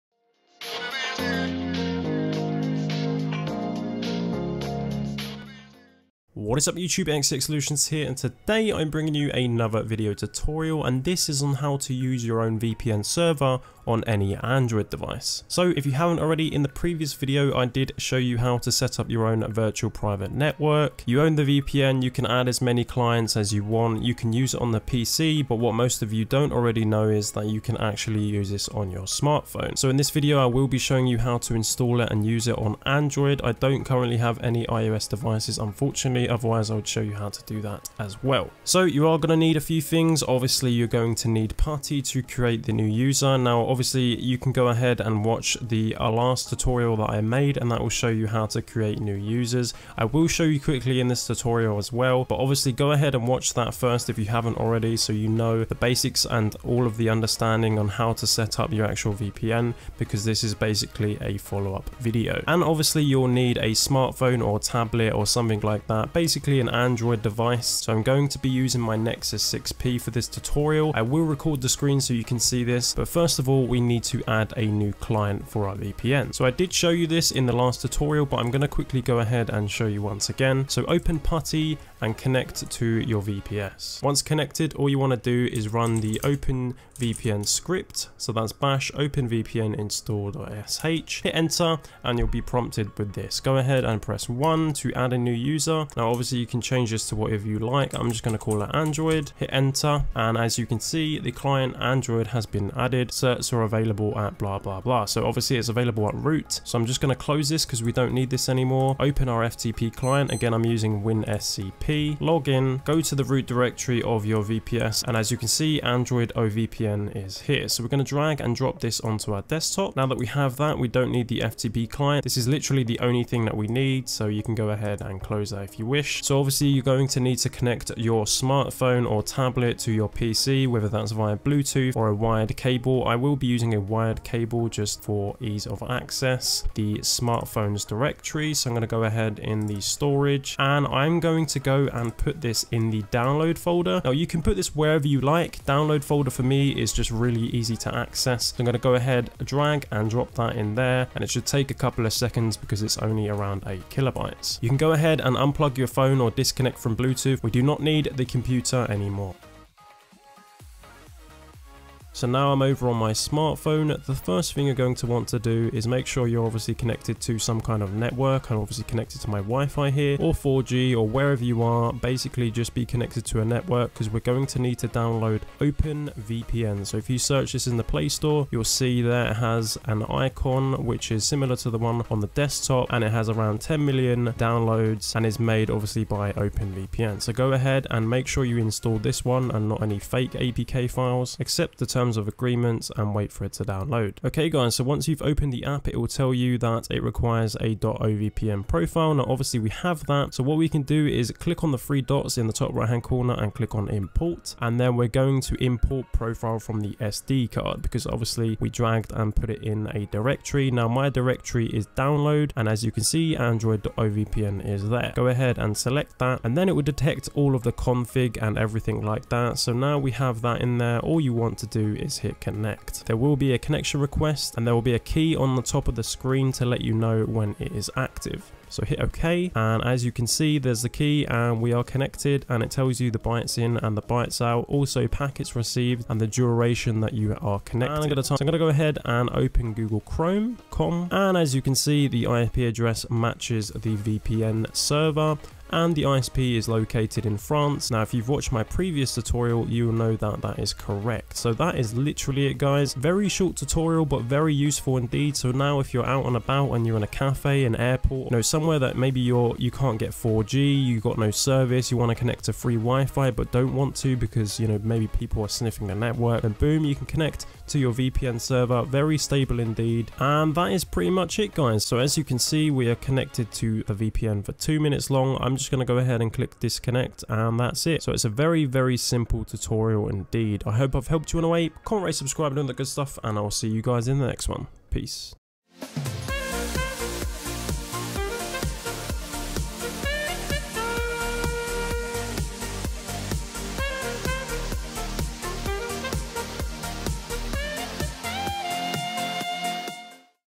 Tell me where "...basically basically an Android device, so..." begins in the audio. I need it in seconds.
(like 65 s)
66 s.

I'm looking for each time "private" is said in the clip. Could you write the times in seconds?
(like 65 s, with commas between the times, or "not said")
19 s.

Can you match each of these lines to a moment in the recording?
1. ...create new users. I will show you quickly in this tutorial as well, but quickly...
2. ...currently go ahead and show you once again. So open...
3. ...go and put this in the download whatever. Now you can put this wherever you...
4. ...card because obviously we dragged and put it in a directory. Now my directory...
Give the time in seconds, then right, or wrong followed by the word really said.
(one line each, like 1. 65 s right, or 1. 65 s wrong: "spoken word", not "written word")
1. 48 s wrong: "obviously", not "quickly"
2. 78 s wrong: "quickly", not "currently"
3. 141 s wrong: "folder", not "whatever"
4. 207 s right.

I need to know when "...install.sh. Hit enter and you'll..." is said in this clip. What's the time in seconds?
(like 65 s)
89 s.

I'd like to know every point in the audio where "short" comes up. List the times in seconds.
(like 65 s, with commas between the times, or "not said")
253 s.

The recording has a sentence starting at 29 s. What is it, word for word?
So in this video I will be showing you how to install it and use it on Android.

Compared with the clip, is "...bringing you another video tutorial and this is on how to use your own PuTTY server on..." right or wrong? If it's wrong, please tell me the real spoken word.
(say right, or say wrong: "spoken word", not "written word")
wrong: "VPN", not "PuTTY".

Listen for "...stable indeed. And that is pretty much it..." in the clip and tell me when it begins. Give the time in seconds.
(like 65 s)
269 s.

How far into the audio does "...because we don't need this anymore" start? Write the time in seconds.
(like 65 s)
107 s.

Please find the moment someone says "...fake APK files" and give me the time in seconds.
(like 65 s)
189 s.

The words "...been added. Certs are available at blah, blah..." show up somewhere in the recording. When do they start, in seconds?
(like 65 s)
102 s.